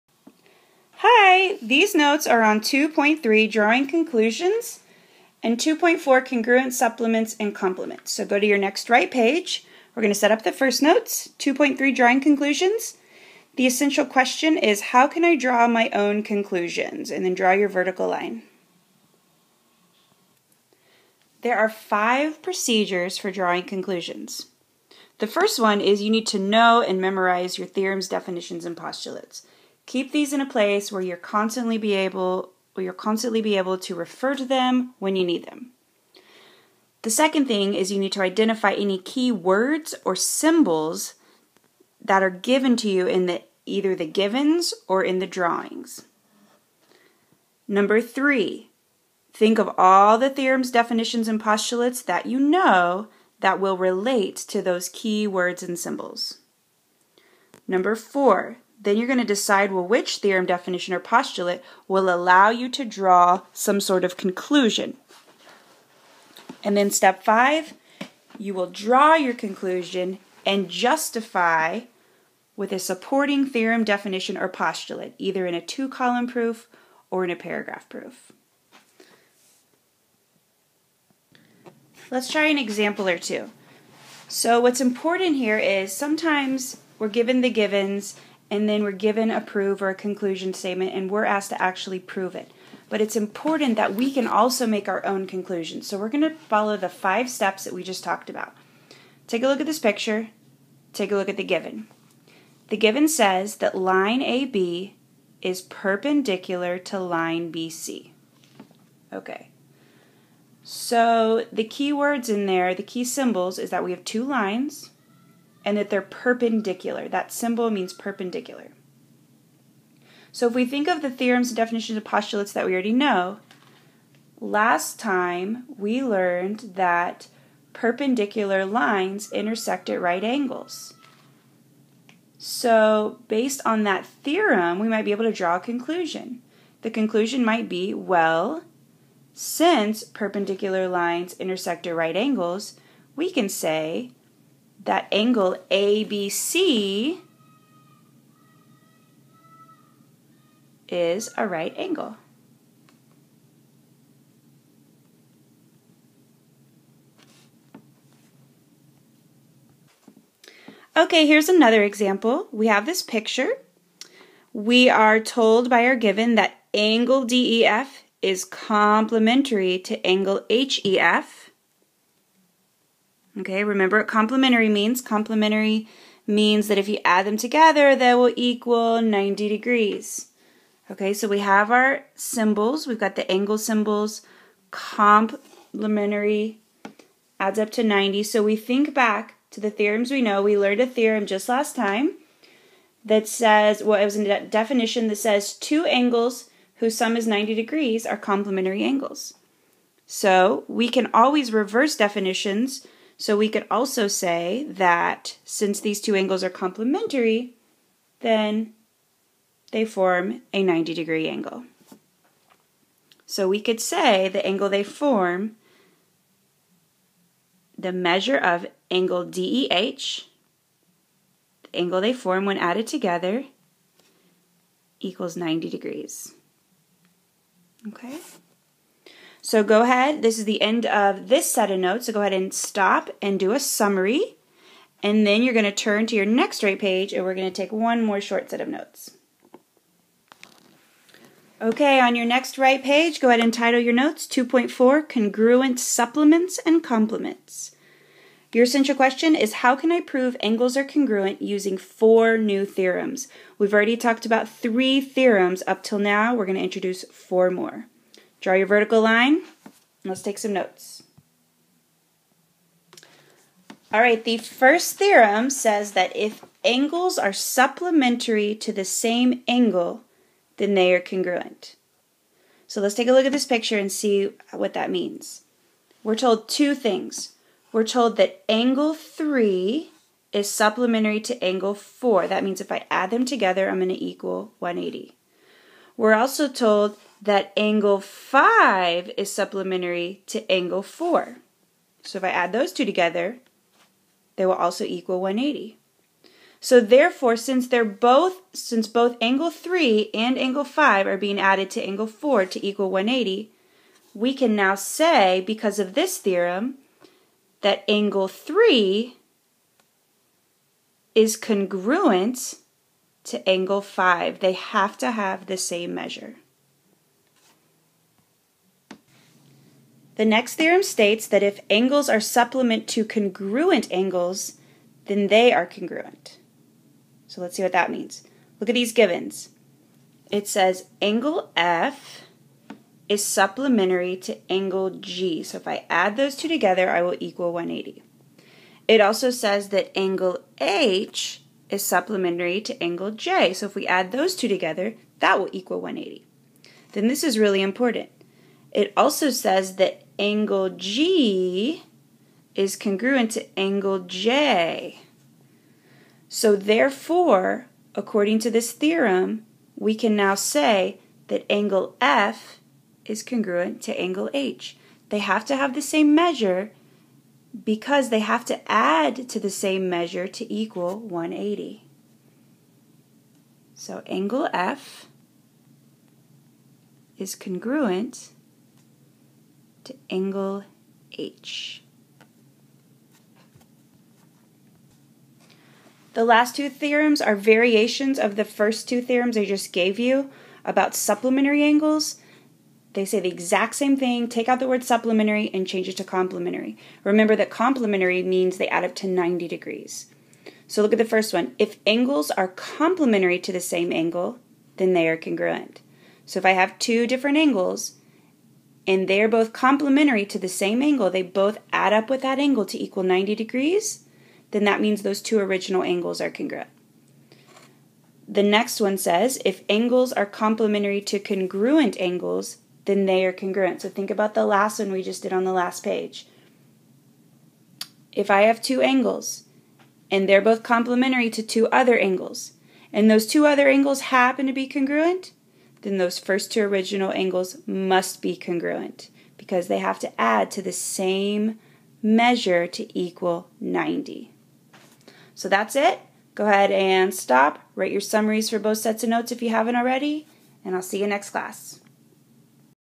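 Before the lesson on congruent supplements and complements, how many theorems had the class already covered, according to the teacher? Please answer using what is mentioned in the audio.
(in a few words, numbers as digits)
3.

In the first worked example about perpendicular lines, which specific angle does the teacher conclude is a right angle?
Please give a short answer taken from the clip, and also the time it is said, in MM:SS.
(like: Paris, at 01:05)
Angle ABC, at 02:25.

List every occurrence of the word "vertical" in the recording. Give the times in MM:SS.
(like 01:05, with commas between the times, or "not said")
00:17, 04:18.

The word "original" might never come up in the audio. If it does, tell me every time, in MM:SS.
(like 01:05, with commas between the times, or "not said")
06:55, 07:16.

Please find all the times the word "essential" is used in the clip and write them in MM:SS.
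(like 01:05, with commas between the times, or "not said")
00:13, 04:08.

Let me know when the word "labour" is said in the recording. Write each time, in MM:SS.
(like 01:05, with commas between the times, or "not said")
not said.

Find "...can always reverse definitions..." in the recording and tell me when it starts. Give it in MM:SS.
03:20.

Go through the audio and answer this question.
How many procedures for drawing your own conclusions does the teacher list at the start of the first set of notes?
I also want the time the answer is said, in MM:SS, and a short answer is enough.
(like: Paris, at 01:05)
5, at 00:21.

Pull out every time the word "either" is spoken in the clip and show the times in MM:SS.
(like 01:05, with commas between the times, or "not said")
00:43, 01:15.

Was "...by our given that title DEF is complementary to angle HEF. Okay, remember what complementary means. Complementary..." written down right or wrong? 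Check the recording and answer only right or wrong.
wrong.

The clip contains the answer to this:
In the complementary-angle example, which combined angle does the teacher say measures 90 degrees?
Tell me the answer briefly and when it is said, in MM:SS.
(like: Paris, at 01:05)
Angle DEH, at 03:38.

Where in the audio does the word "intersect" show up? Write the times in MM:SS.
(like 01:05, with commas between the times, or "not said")
02:09, 02:21.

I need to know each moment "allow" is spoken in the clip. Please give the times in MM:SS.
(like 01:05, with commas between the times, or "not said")
01:02.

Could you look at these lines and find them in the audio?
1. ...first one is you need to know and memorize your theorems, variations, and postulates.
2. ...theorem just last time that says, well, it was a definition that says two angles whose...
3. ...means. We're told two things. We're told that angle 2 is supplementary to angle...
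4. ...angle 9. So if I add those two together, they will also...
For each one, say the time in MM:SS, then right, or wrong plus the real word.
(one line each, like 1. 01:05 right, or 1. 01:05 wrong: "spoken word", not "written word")
1. 00:25 wrong: "definitions", not "variations"
2. 03:10 right
3. 04:34 wrong: "3", not "2"
4. 04:50 wrong: "4", not "9".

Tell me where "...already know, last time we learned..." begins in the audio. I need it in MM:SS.
02:02.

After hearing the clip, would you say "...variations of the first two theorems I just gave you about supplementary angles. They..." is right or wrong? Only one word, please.
right.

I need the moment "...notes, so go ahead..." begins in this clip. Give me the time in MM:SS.
03:51.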